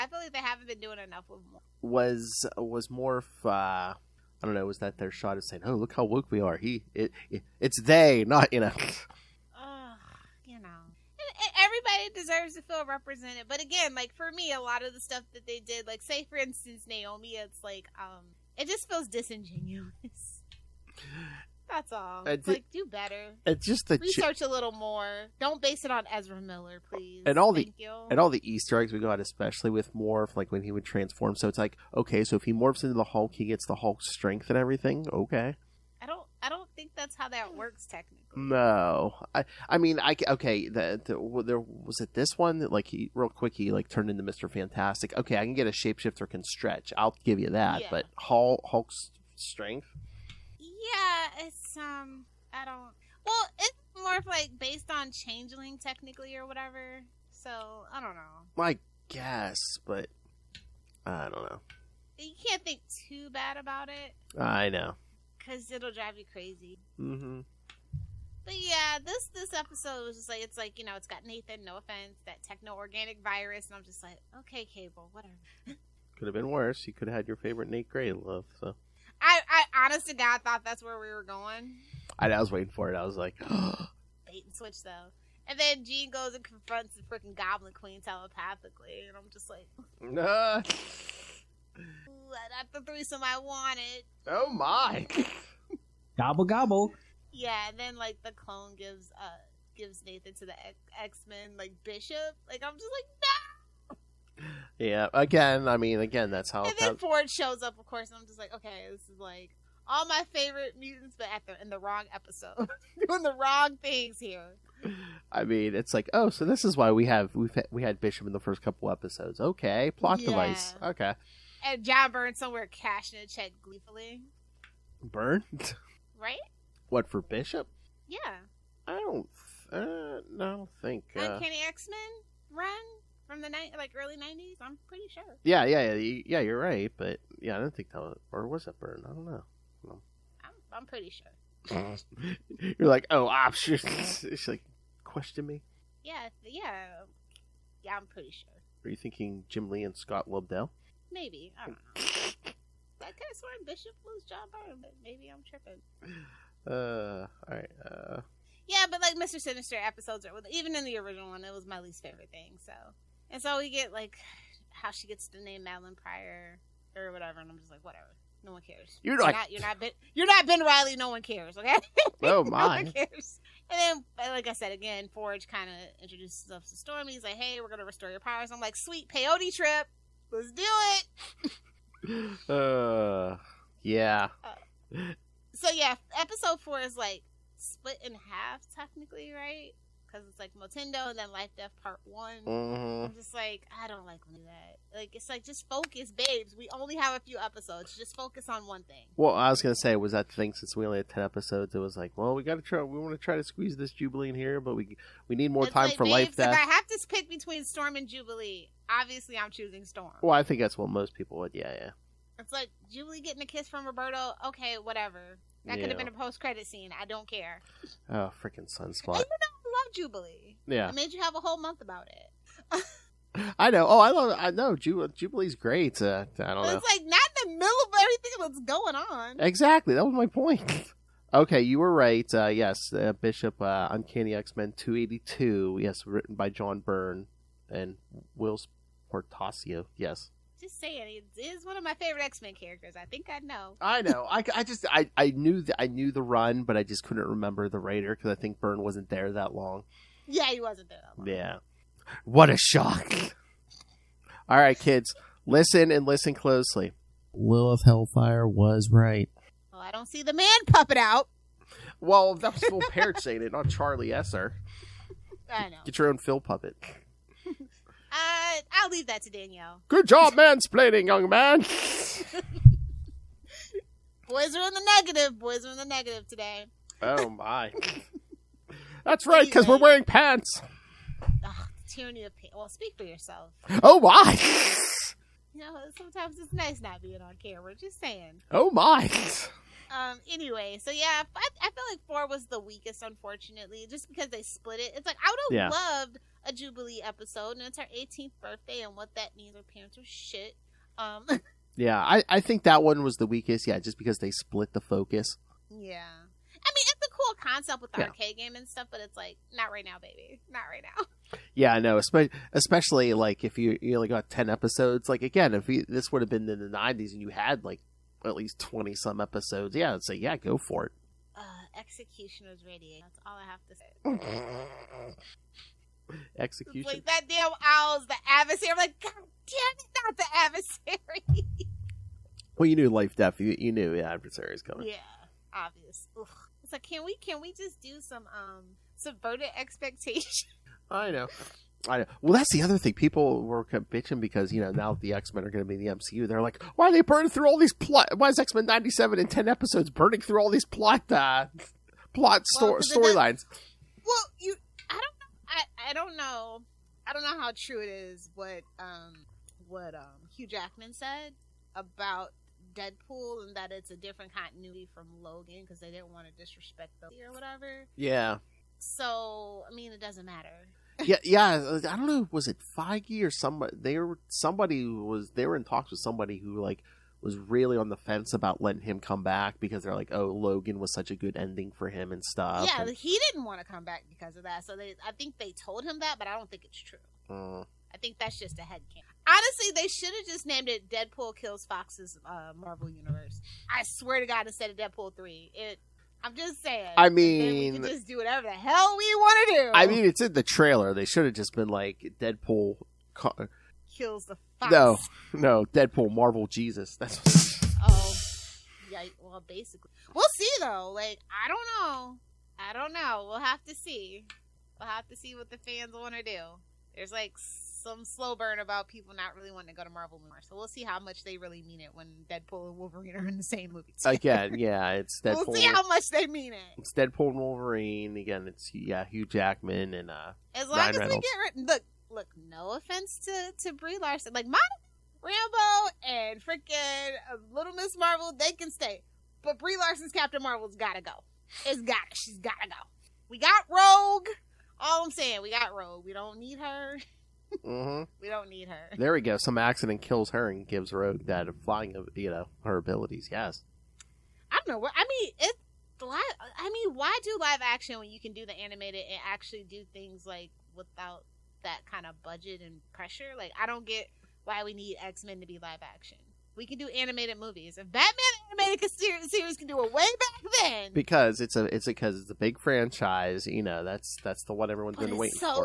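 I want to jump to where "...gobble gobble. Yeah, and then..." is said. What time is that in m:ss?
1:36.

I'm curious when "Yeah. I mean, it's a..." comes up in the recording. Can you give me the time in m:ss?
5:05.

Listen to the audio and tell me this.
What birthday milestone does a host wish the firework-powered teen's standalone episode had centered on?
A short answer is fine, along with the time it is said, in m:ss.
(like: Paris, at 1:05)
18th, at 4:57.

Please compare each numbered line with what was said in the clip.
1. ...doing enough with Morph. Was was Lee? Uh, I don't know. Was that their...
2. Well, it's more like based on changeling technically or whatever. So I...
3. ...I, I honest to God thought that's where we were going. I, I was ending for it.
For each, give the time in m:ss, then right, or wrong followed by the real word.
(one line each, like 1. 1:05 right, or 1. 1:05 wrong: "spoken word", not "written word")
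1. 0:00 wrong: "Morph", not "Lee"
2. 0:53 right
3. 1:19 wrong: "waiting", not "ending".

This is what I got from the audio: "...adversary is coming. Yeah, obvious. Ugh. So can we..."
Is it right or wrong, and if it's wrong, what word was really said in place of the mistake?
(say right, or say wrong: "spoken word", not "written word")
right.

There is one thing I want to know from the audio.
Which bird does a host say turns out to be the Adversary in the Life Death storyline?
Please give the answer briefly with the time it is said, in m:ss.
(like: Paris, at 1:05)
owl, at 5:27.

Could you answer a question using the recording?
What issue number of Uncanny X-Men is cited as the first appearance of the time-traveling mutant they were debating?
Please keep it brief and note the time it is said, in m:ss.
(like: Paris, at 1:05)
282, at 3:54.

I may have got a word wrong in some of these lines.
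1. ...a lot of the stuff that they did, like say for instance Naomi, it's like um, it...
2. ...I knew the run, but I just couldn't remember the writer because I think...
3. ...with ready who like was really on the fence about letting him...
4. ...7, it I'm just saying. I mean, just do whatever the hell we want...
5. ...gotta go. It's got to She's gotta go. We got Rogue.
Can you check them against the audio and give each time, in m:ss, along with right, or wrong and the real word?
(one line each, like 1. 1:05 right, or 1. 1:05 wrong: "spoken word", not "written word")
1. 0:14 right
2. 4:05 right
3. 6:15 wrong: "somebody", not "ready"
4. 6:35 wrong: "3", not "7"
5. 7:20 right.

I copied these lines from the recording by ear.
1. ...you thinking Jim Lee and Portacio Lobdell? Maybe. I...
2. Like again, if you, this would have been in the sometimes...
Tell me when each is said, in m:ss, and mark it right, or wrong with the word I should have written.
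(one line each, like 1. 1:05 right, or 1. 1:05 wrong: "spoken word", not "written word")
1. 2:28 wrong: "Scott", not "Portacio"
2. 5:15 wrong: "nineties", not "sometimes".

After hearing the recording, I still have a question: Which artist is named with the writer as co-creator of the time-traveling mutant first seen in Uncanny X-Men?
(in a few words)
Whilce Portacio.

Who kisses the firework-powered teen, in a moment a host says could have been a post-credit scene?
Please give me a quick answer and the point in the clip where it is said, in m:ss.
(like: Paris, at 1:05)
Roberto, at 3:33.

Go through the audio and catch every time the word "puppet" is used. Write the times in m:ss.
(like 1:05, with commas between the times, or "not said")
4:20, 4:26.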